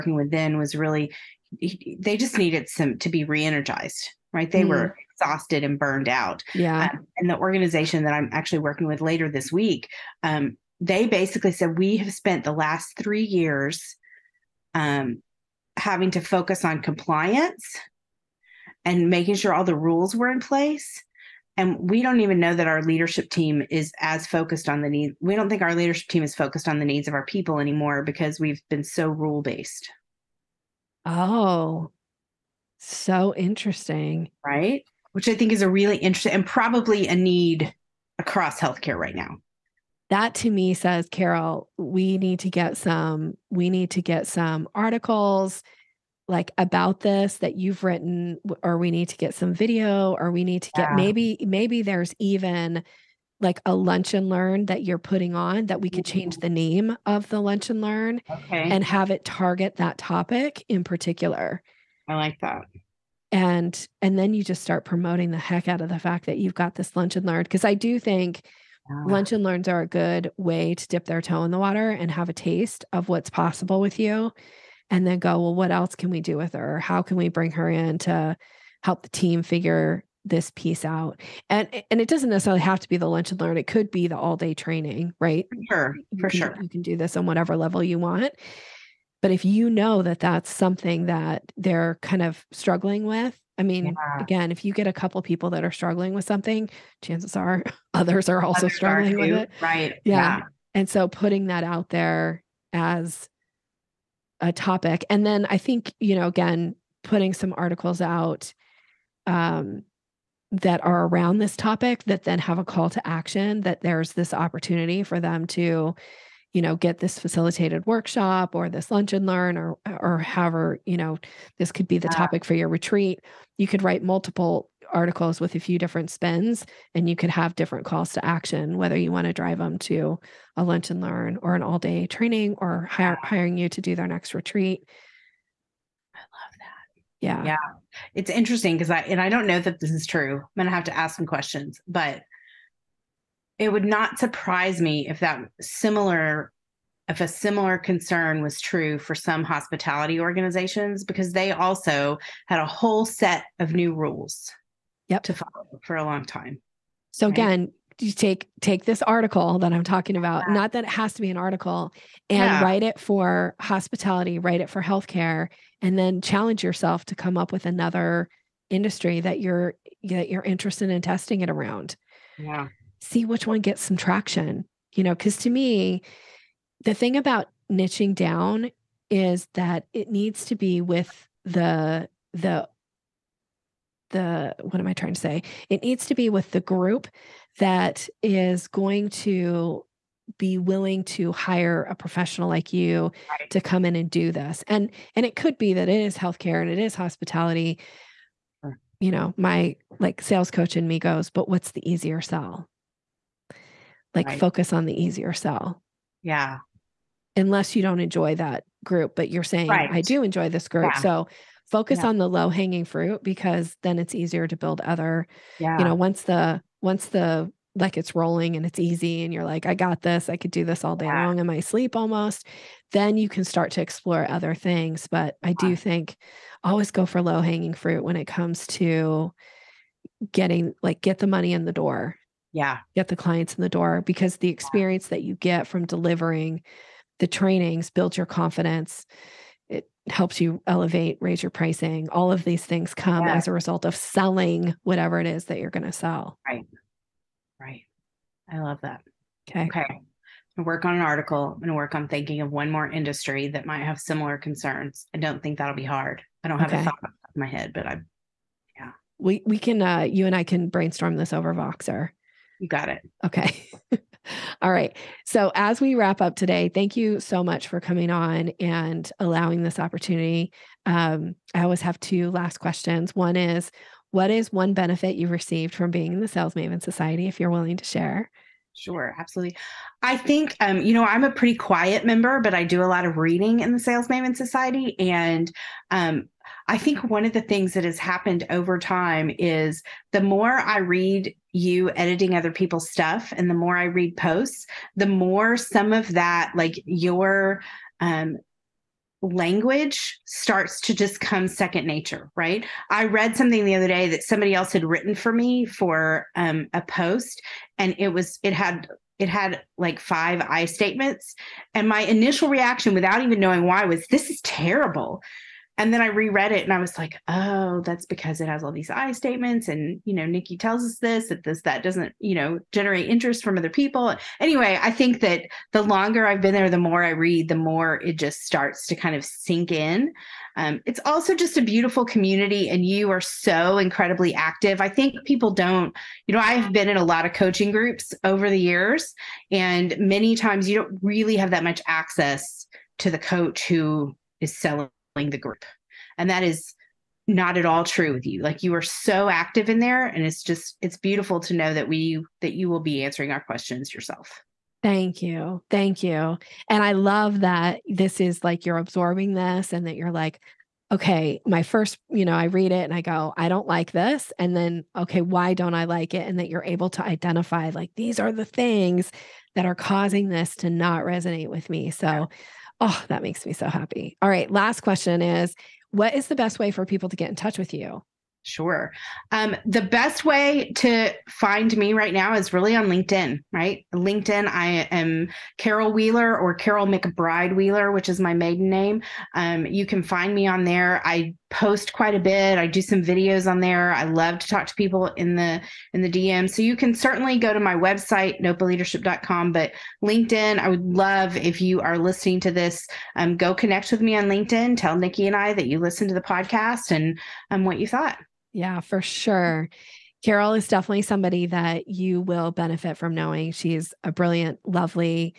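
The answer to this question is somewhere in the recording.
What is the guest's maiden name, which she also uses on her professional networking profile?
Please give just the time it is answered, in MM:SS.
06:26.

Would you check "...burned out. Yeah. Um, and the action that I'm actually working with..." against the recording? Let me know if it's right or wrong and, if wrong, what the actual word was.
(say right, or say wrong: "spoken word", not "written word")
wrong: "organization", not "action".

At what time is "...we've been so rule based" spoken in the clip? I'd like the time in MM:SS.
00:28.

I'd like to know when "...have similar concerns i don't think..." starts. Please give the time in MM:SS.
04:13.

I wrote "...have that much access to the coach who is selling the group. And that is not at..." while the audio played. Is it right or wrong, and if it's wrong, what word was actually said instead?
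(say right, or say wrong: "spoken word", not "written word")
right.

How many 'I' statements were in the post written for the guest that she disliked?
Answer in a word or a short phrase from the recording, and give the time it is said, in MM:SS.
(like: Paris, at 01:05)
5, at 05:09.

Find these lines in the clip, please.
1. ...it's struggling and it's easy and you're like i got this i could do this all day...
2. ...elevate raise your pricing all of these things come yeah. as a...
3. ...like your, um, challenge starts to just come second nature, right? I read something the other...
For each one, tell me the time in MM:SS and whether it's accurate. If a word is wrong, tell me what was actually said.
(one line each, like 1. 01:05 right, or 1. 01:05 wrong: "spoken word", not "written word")
1. 03:37 wrong: "rolling", not "struggling"
2. 04:00 right
3. 04:56 wrong: "language", not "challenge".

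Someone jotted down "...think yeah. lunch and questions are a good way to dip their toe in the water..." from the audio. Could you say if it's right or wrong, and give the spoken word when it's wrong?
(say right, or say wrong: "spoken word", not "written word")
wrong: "learns", not "questions".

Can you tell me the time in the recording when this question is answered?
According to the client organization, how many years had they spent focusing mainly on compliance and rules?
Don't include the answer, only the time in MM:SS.
00:12.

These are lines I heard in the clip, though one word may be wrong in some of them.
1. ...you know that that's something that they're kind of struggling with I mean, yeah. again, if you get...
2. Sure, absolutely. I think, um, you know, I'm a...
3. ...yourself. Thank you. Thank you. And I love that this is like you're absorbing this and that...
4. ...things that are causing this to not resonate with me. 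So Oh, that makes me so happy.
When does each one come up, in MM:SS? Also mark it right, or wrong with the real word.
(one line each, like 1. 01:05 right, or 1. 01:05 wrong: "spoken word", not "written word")
1. 01:29 right
2. 04:38 right
3. 05:53 right
4. 06:08 right.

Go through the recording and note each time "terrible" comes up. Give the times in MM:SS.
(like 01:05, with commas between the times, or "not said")
05:14.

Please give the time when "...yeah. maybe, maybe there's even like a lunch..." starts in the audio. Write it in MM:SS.
00:50.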